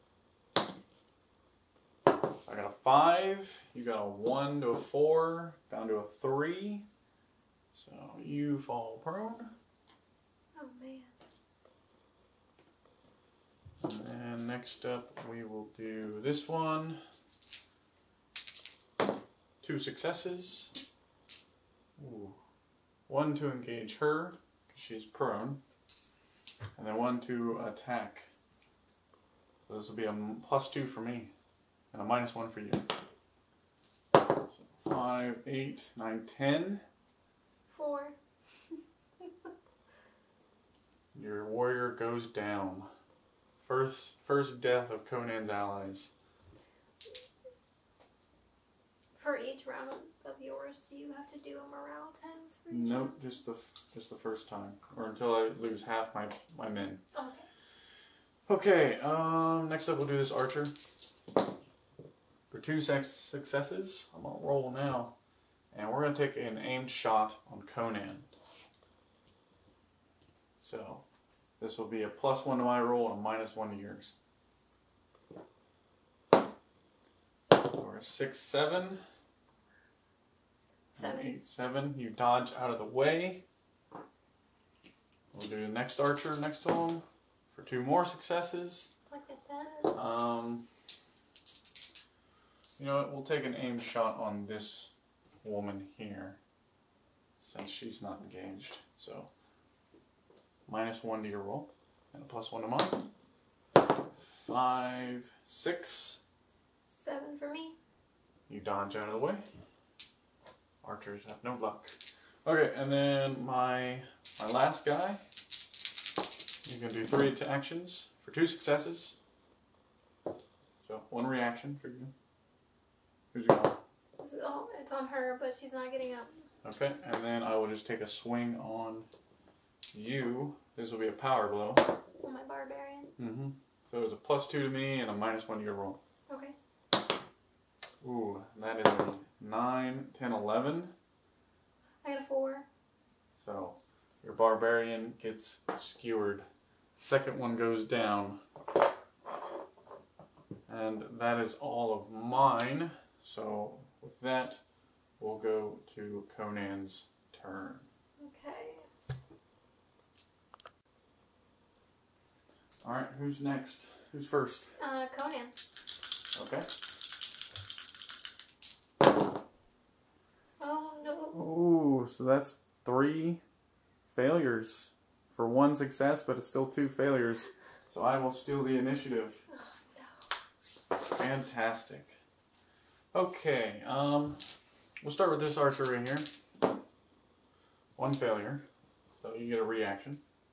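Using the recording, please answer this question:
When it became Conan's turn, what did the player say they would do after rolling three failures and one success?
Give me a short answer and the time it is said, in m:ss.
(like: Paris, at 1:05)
Steal the initiative, at 2:58.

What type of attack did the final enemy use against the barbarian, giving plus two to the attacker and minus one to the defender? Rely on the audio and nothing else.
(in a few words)
Power blow.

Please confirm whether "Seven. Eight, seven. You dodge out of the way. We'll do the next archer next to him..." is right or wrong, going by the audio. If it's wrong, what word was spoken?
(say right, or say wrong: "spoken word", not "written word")
right.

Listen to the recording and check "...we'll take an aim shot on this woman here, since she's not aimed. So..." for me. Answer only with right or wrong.
wrong.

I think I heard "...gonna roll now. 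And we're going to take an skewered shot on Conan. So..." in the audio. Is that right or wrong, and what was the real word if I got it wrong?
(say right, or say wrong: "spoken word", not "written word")
wrong: "aimed", not "skewered".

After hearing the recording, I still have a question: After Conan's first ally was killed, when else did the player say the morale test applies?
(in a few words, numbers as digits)
Just the first time.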